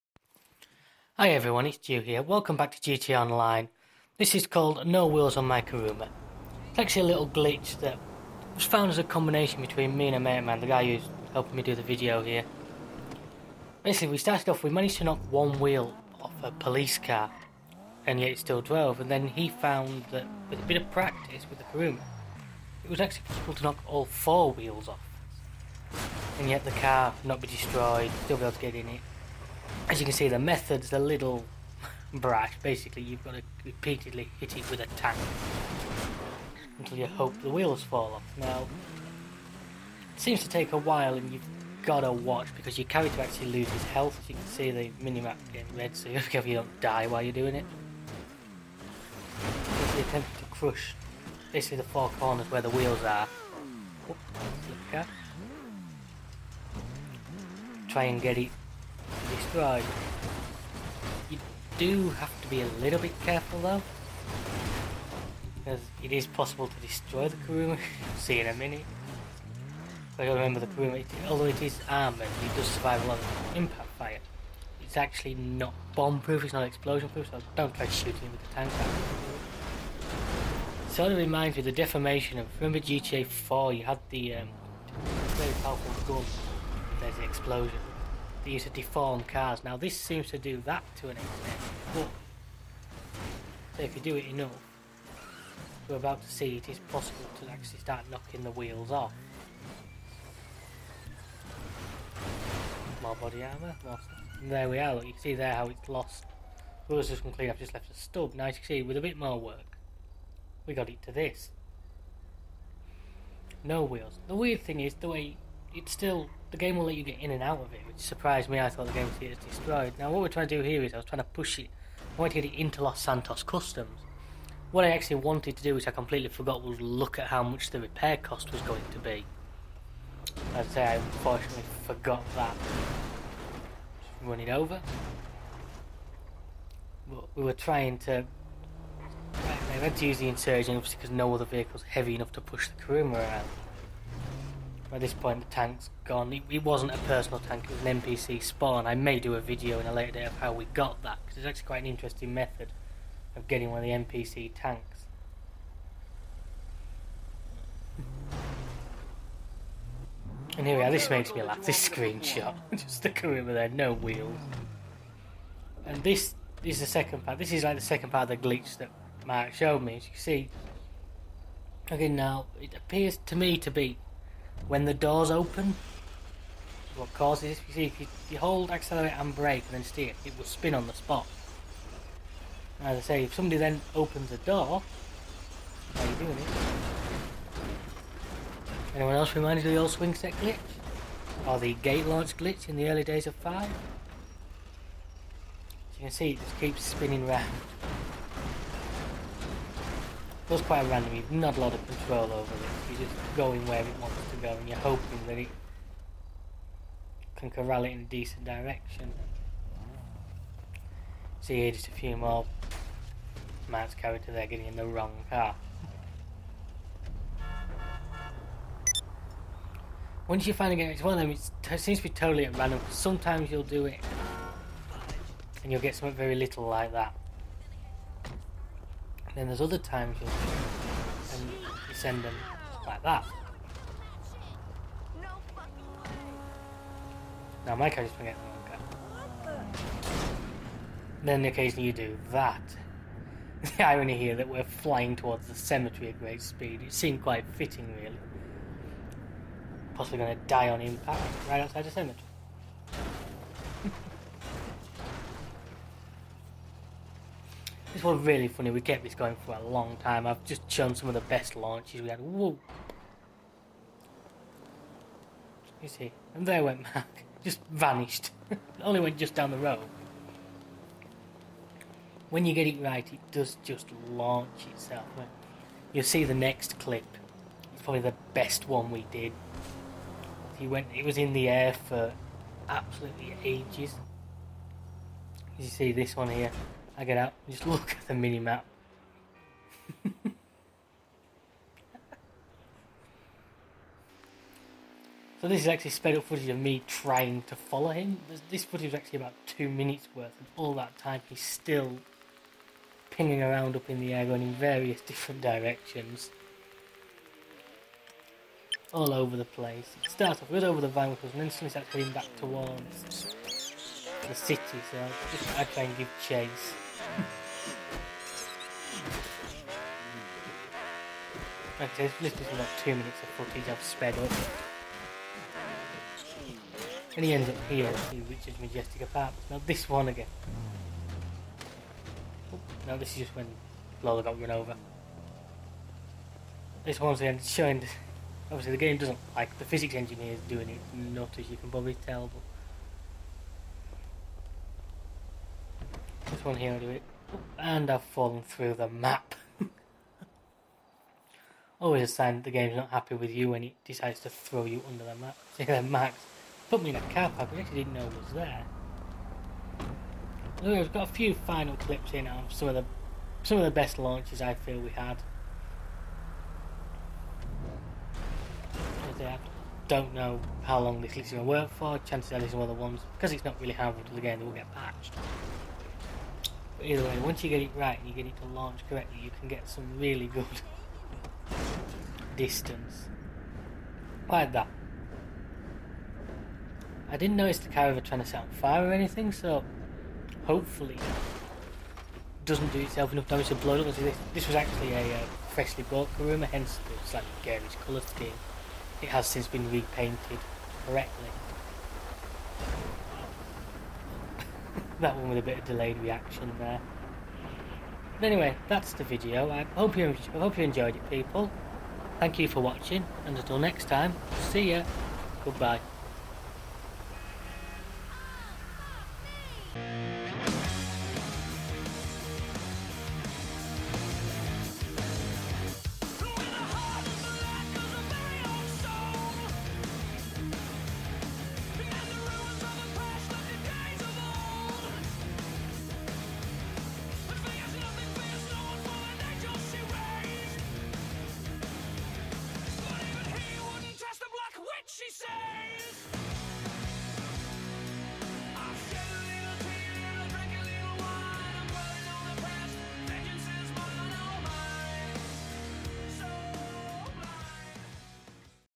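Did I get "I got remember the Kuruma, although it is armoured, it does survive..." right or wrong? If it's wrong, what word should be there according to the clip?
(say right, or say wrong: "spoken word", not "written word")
right.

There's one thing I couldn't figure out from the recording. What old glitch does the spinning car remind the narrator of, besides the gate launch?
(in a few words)
Swing set glitch.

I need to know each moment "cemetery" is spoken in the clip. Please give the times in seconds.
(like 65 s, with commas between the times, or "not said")
245 s, 251 s.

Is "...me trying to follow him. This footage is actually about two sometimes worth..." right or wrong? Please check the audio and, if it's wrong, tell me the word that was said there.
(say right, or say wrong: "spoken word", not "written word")
wrong: "minutes", not "sometimes".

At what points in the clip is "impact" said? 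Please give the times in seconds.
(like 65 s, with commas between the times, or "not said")
73 s, 250 s.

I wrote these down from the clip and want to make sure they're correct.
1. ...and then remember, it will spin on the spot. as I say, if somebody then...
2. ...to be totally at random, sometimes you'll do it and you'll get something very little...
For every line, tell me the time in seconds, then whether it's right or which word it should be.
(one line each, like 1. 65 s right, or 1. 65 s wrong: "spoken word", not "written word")
1. 179 s wrong: "steer", not "remember"
2. 221 s right.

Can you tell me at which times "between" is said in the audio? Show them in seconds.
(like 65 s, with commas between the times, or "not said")
9 s.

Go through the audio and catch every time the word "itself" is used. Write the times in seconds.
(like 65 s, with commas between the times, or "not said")
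274 s, 392 s.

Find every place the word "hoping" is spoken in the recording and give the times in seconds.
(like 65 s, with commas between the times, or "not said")
204 s.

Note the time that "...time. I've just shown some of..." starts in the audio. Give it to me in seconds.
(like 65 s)
259 s.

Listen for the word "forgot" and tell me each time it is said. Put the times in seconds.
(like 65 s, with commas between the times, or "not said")
126 s, 131 s.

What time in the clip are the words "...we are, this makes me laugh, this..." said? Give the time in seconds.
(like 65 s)
160 s.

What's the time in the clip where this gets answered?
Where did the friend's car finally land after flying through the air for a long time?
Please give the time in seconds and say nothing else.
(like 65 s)
328 s.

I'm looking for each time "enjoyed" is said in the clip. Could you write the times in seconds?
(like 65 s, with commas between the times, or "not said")
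410 s.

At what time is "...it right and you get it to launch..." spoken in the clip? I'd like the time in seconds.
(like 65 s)
377 s.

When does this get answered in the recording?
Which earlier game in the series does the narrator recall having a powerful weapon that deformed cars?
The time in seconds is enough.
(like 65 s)
82 s.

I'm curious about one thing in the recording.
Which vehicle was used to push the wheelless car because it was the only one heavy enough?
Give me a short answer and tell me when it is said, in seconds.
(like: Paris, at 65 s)
Insurgent, at 140 s.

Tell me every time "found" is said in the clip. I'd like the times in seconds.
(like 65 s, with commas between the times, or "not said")
8 s, 19 s.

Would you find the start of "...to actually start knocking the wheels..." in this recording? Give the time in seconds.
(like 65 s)
97 s.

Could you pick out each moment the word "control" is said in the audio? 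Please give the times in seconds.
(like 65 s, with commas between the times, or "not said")
201 s.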